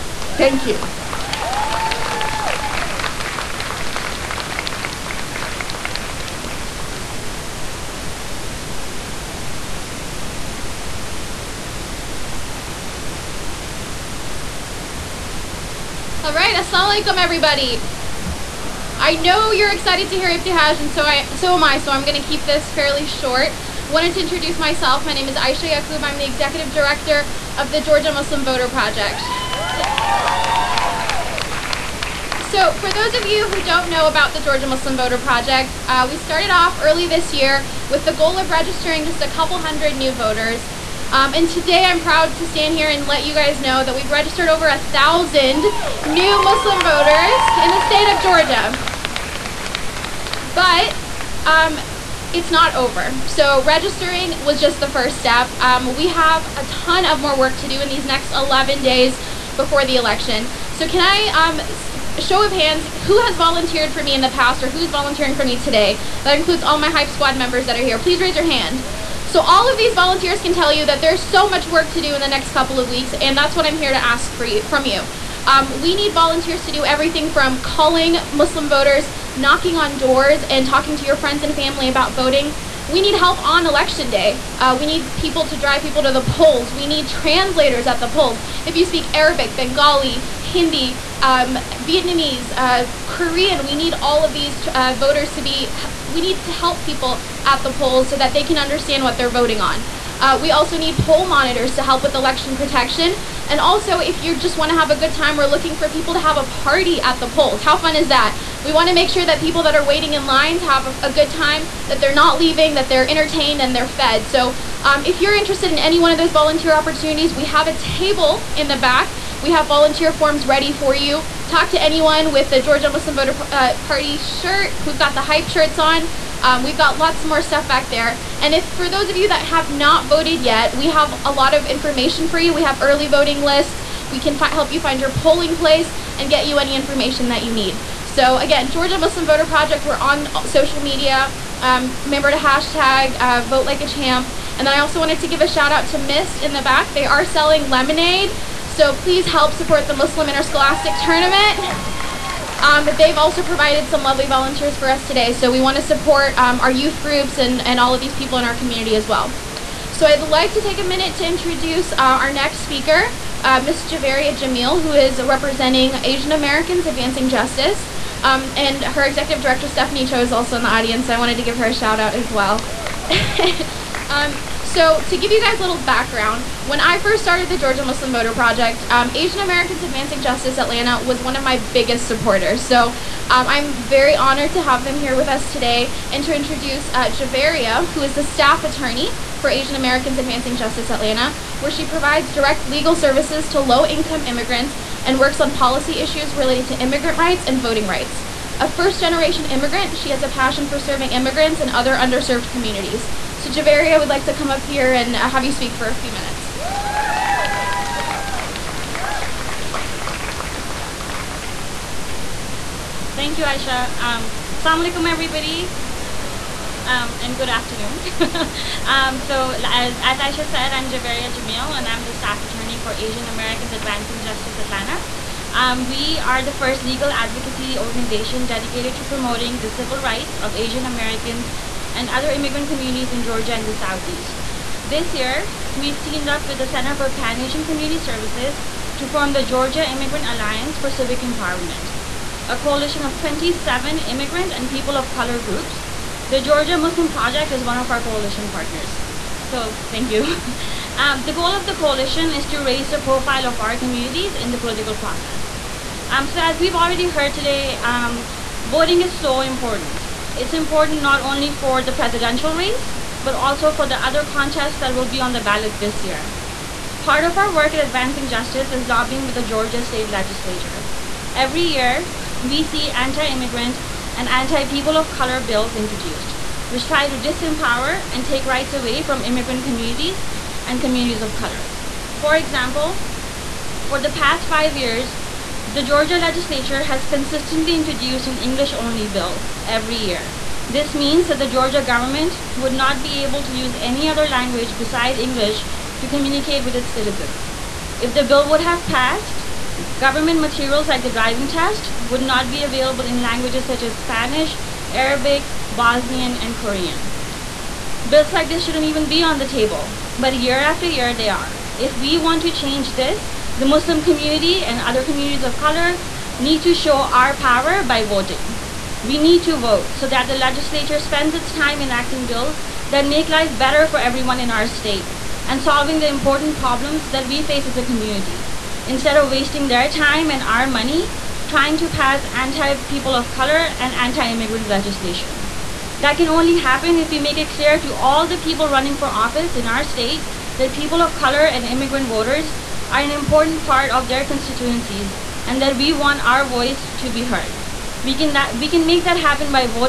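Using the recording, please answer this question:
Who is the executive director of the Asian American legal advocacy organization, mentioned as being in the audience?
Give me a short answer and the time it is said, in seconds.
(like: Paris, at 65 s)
Stephanie Cho, at 169 s.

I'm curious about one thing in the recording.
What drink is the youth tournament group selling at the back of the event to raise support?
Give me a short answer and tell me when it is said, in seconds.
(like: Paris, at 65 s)
lemonade, at 147 s.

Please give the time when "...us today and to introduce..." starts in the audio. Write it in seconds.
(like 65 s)
185 s.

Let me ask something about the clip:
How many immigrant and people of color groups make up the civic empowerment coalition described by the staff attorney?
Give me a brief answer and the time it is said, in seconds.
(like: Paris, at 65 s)
27, at 243 s.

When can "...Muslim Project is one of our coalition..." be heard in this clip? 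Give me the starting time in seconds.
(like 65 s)
246 s.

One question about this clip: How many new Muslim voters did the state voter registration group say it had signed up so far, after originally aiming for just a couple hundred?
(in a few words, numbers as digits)
over 1,000.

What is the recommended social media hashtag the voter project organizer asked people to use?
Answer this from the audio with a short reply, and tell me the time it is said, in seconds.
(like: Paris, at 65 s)
vote like a champ, at 143 s.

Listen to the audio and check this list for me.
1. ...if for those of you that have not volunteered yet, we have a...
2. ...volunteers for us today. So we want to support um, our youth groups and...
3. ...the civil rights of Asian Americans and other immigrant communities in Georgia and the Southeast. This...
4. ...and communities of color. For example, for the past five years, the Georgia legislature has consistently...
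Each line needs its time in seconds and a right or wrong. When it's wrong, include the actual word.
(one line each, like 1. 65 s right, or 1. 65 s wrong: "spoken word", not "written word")
1. 128 s wrong: "voted", not "volunteered"
2. 154 s right
3. 229 s right
4. 280 s right.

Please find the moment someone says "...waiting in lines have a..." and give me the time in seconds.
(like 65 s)
109 s.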